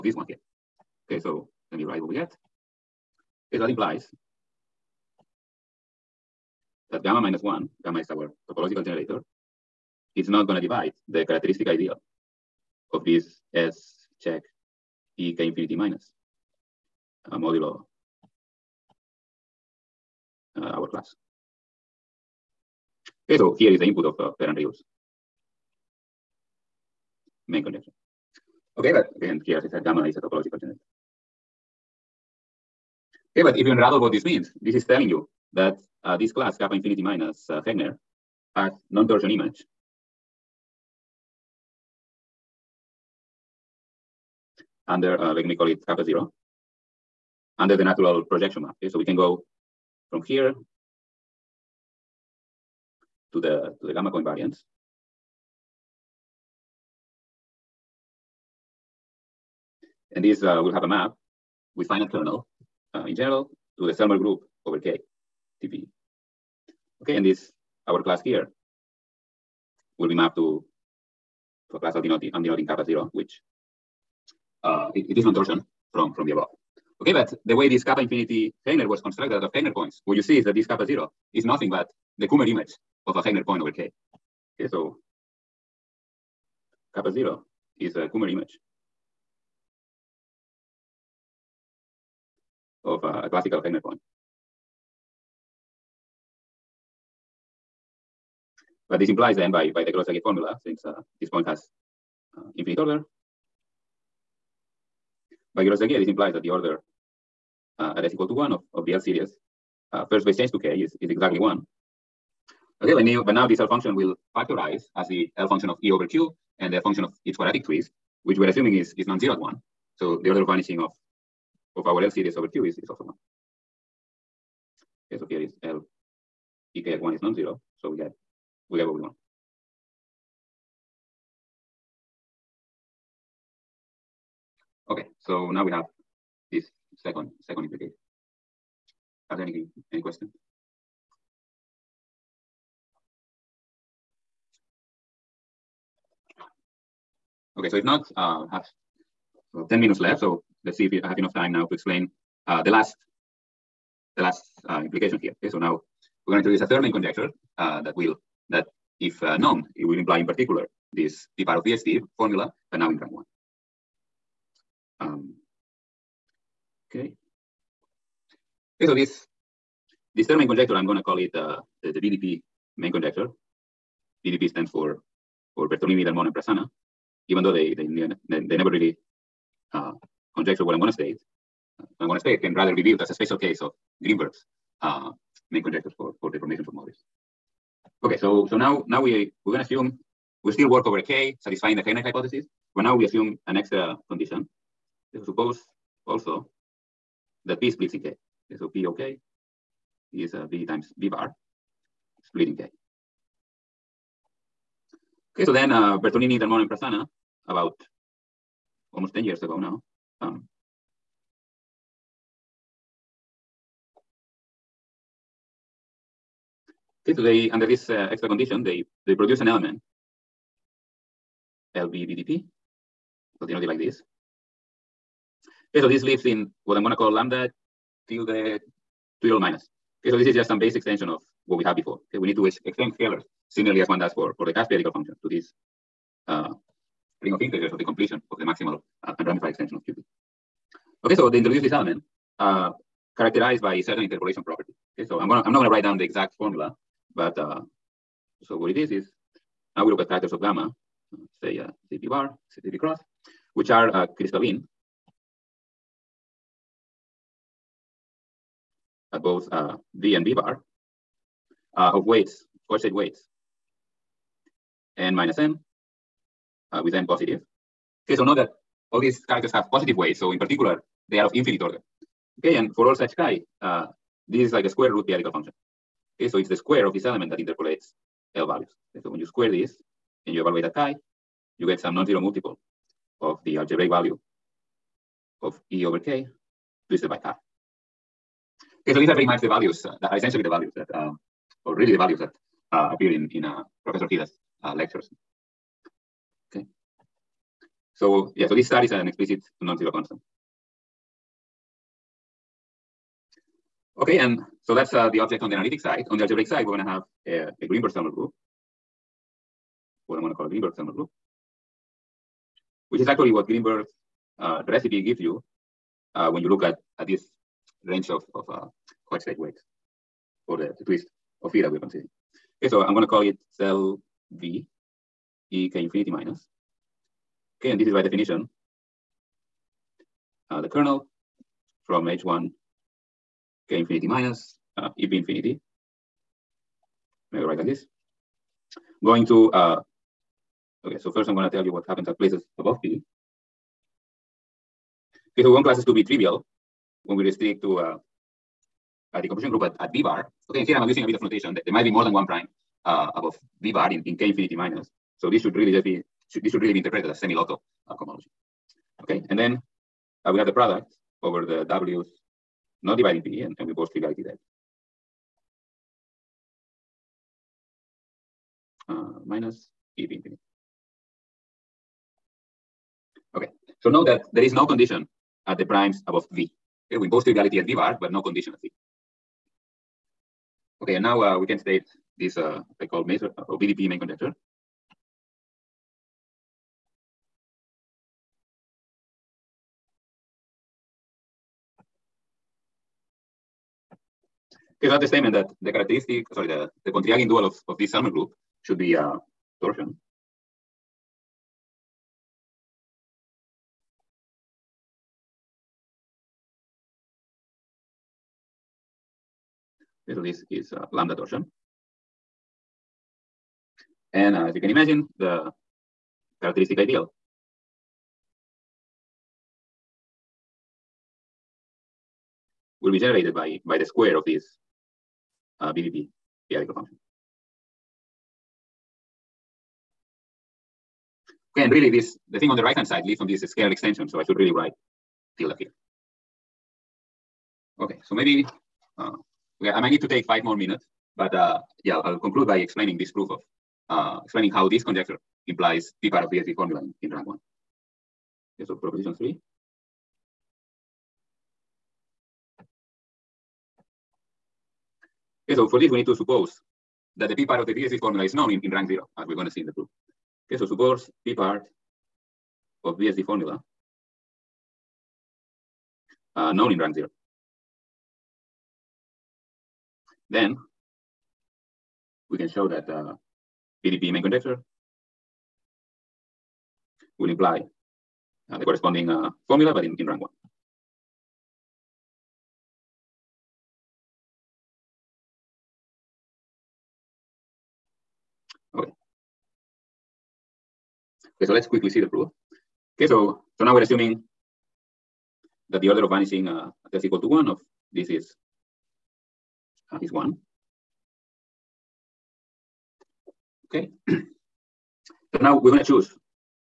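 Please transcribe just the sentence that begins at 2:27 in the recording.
Okay, so if not, uh, have well, 10 minutes left.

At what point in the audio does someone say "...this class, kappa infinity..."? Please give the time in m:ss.
0:36.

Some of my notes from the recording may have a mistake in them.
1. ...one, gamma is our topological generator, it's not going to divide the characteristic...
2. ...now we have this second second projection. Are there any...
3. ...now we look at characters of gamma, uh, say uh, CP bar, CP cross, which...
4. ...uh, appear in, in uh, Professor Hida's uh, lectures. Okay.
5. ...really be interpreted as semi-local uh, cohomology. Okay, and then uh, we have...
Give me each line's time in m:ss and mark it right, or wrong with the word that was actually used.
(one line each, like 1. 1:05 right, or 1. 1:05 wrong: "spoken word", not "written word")
1. 0:07 right
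2. 2:15 wrong: "implication", not "projection"
3. 4:09 wrong: "titers", not "characters"
4. 4:52 right
5. 5:56 right.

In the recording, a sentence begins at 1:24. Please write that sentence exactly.
Okay, so kappa zero is a Kummer image.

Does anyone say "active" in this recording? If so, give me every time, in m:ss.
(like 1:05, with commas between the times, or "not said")
not said.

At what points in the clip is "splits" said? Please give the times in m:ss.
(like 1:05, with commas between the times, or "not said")
3:17, 3:22.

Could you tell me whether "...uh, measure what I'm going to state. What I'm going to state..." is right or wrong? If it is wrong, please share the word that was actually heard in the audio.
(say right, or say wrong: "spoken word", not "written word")
wrong: "conjecture", not "measure".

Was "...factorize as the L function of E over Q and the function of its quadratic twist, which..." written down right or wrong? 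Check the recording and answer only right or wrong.
right.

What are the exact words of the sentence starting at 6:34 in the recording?
Okay, that's the statement that the characteristic, sorry, the, the Pontryagin dual of, of this Selmer group should be uh, torsion.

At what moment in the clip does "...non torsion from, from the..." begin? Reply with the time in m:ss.
1:15.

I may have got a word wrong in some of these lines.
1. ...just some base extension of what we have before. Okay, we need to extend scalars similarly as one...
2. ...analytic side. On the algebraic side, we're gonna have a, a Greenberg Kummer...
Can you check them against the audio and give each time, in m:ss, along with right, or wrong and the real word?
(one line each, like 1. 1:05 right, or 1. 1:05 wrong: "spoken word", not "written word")
1. 3:50 right
2. 5:05 wrong: "Selmer", not "Kummer".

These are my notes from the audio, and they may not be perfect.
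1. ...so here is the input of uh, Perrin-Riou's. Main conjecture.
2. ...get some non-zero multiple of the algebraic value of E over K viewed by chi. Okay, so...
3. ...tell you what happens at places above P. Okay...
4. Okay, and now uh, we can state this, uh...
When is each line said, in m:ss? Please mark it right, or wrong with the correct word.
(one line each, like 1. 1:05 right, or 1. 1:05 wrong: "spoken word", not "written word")
1. 0:23 right
2. 4:41 wrong: "twisted", not "viewed"
3. 5:41 right
4. 6:20 right.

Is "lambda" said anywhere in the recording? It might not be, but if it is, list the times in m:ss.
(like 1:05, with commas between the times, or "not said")
3:47, 6:50.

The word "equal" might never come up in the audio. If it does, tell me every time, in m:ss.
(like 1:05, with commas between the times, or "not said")
1:48, 8:17.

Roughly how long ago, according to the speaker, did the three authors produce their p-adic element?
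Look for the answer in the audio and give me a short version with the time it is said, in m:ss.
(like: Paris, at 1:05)
almost 10 years, at 3:28.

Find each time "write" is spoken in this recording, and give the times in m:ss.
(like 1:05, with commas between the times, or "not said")
0:01, 4:05, 5:37, 7:14.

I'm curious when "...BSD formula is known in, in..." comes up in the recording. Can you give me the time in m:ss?
7:37.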